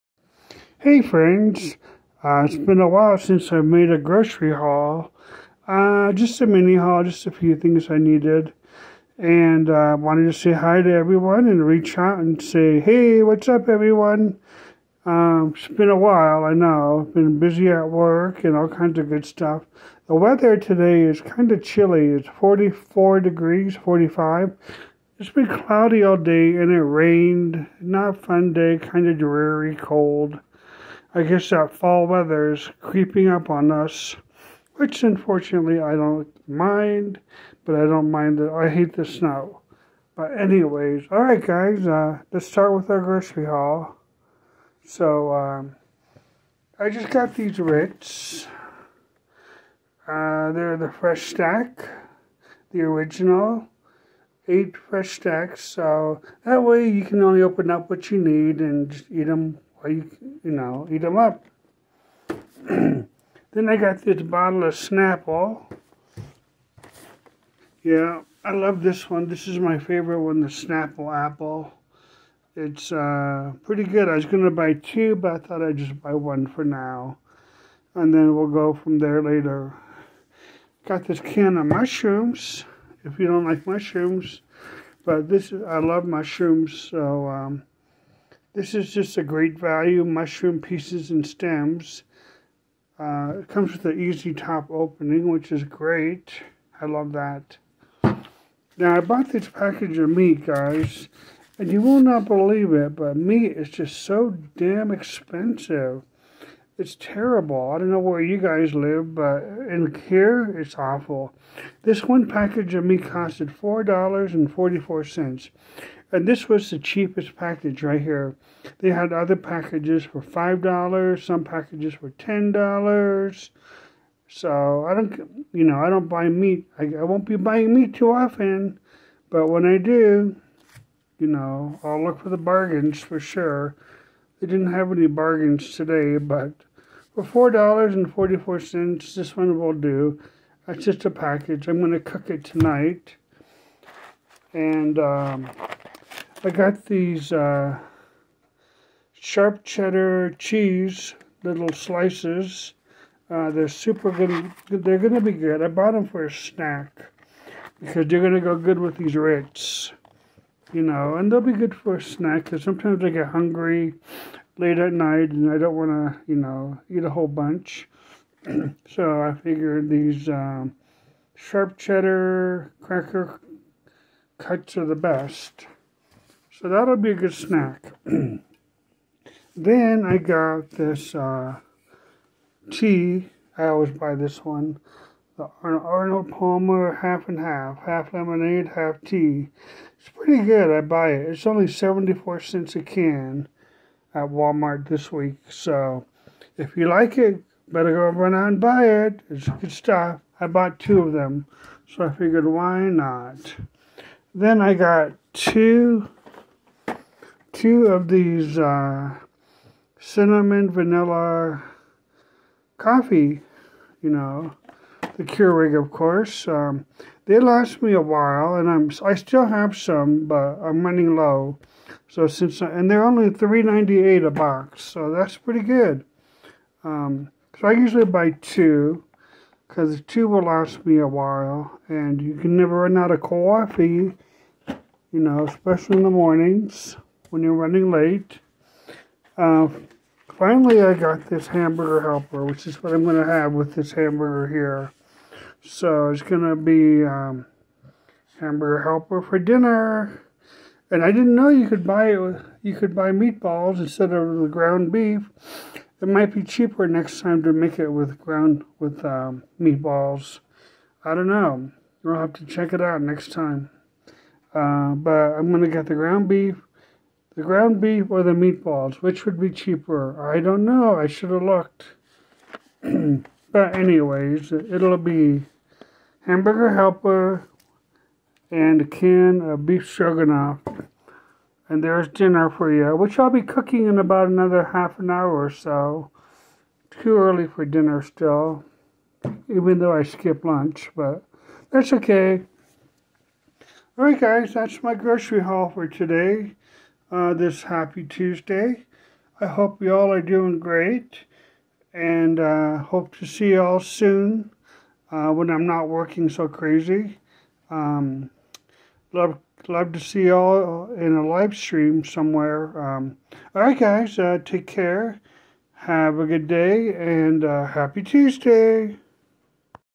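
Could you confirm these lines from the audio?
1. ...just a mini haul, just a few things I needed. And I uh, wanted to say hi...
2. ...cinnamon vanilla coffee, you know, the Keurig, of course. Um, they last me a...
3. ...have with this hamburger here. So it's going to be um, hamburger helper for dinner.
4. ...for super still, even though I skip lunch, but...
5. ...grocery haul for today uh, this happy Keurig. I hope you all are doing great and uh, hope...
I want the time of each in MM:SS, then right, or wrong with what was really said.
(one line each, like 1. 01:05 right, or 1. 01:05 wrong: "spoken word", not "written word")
1. 00:06 right
2. 03:29 right
3. 04:03 right
4. 04:47 wrong: "dinner", not "super"
5. 04:54 wrong: "Tuesday", not "Keurig".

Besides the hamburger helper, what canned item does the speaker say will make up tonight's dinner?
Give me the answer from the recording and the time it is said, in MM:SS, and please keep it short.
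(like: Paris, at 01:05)
beef stroganoff, at 04:39.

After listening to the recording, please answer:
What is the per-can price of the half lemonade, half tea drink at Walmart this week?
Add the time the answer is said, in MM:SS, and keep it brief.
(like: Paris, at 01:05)
74 cents, at 03:11.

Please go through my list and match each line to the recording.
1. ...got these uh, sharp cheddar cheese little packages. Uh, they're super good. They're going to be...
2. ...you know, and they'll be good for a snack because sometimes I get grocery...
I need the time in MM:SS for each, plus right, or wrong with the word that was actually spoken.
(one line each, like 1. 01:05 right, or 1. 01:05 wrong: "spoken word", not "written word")
1. 02:26 wrong: "slices", not "packages"
2. 02:40 wrong: "hungry", not "grocery".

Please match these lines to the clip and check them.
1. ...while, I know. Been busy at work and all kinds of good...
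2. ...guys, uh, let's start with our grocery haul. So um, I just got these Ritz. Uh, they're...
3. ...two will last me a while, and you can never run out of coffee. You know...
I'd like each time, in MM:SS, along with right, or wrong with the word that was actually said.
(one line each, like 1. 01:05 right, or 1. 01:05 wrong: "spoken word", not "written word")
1. 00:15 right
2. 00:41 right
3. 03:50 right.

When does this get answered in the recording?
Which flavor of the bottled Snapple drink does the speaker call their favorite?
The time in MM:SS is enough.
01:10.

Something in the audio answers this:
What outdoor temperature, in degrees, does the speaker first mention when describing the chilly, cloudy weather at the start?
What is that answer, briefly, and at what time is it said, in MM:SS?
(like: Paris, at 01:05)
44, at 00:22.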